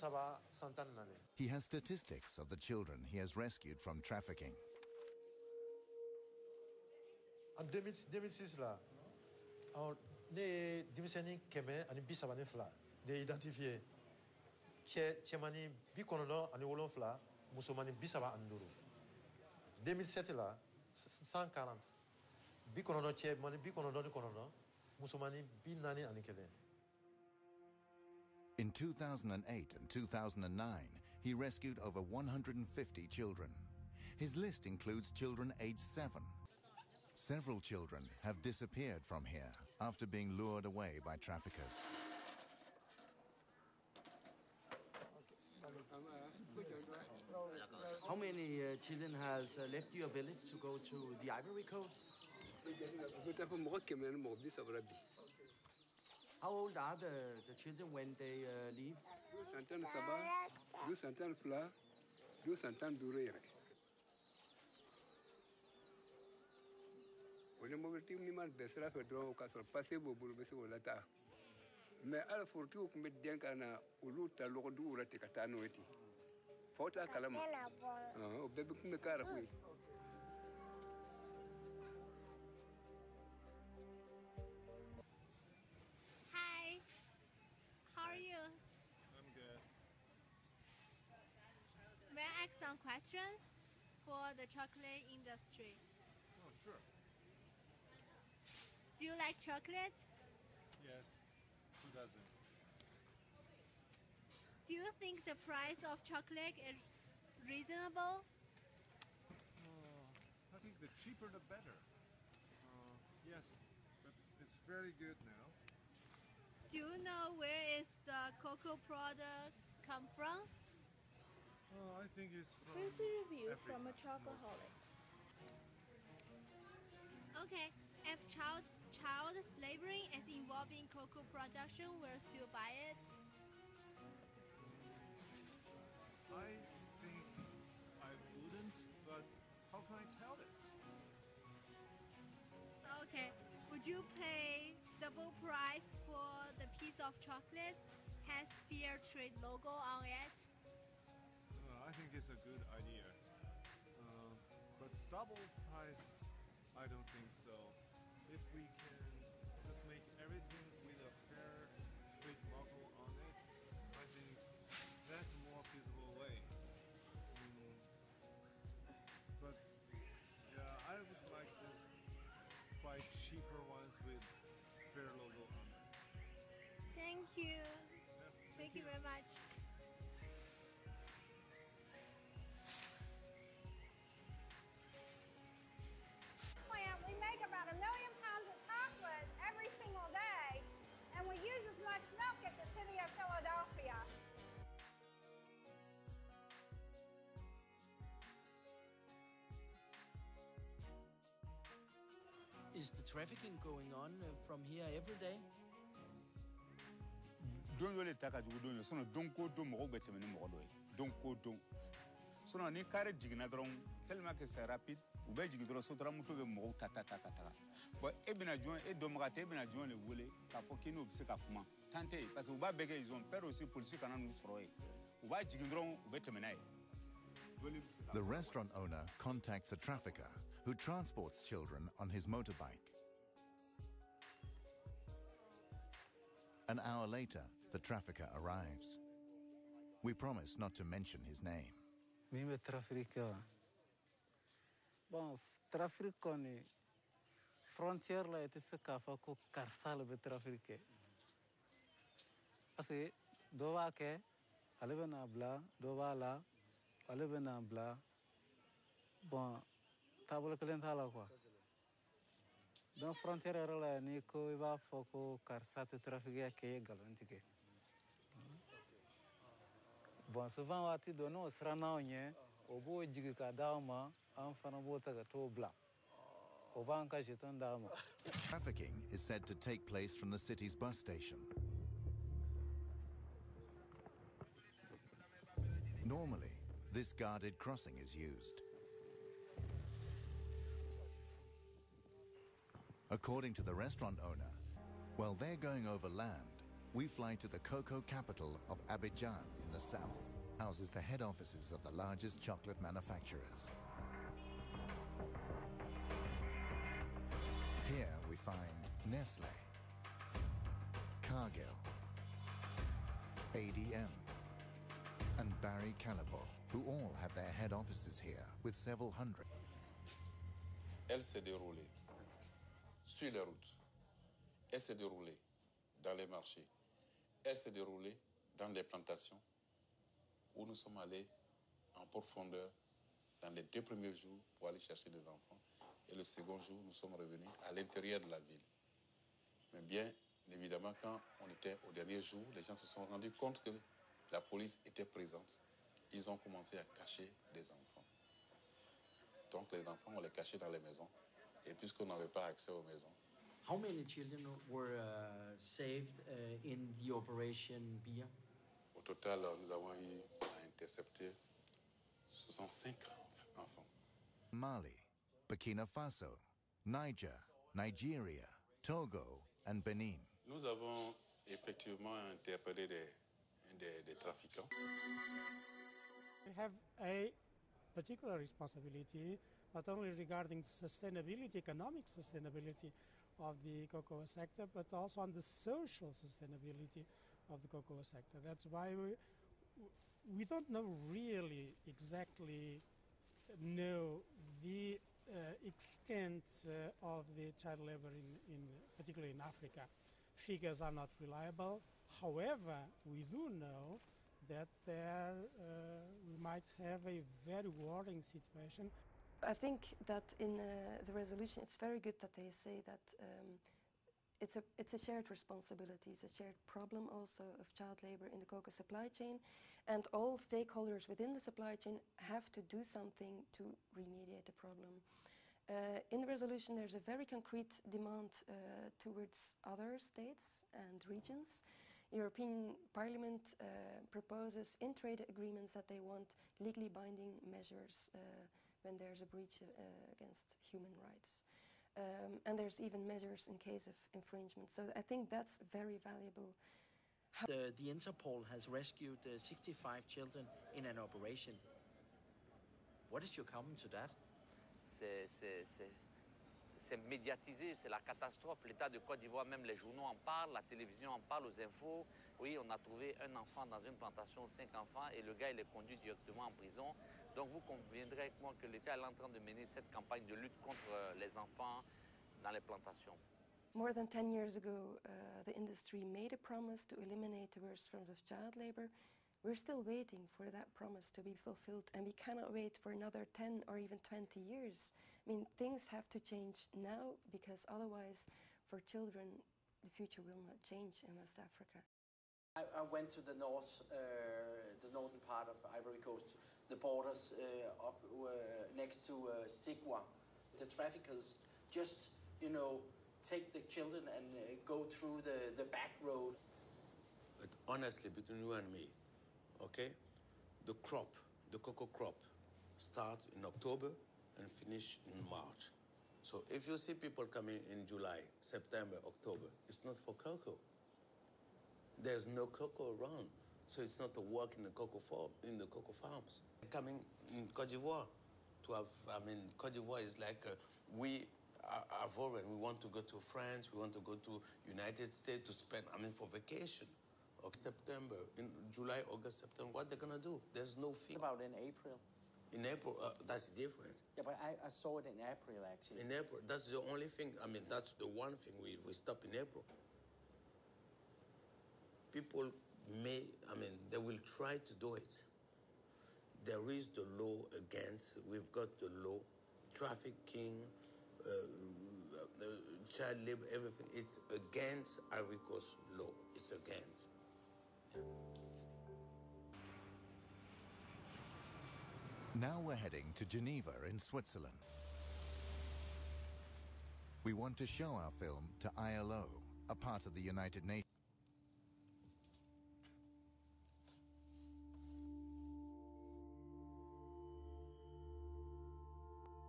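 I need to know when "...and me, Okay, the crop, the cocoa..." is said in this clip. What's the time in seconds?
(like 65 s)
508 s.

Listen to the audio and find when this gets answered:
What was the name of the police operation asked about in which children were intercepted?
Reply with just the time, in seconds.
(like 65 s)
357 s.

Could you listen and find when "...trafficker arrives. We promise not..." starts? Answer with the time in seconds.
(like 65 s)
237 s.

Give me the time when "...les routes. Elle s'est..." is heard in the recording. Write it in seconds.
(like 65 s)
323 s.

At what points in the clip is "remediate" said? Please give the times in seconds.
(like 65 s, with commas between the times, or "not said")
423 s.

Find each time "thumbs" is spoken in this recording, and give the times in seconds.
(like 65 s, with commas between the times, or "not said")
not said.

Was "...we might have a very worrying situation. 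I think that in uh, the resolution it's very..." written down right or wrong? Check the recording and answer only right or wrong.
right.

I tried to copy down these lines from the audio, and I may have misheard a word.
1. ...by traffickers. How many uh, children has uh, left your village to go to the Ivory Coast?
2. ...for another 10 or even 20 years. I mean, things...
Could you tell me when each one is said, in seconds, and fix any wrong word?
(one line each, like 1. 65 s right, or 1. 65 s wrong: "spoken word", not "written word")
1. 40 s right
2. 482 s right.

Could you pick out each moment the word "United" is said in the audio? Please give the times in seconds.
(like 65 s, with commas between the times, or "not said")
534 s, 580 s.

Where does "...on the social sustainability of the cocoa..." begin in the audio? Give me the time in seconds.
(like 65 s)
385 s.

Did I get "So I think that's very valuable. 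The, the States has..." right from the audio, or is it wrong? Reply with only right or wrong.
wrong.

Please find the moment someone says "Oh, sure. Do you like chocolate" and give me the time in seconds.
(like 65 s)
96 s.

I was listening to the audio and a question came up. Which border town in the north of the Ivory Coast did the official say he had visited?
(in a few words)
Zegoua.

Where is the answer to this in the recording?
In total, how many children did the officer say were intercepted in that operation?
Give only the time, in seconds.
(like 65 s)
362 s.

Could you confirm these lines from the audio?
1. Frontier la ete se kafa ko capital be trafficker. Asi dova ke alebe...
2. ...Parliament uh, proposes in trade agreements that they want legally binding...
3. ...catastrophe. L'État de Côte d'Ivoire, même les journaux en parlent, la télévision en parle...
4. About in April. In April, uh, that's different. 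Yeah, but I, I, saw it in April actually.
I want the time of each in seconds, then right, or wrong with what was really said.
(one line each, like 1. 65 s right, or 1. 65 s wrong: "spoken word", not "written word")
1. 247 s wrong: "karsal", not "capital"
2. 432 s right
3. 457 s right
4. 541 s right.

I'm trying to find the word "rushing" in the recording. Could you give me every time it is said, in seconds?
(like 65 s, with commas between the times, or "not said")
not said.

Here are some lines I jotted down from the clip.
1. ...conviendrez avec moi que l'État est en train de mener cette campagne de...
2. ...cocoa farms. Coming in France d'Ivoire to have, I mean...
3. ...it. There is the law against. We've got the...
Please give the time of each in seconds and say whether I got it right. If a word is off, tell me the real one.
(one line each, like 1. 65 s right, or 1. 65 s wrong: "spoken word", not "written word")
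1. 467 s right
2. 525 s wrong: "Cote", not "France"
3. 554 s right.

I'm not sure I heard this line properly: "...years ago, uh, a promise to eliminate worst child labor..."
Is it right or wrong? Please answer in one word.
right.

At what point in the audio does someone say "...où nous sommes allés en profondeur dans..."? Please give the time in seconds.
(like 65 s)
330 s.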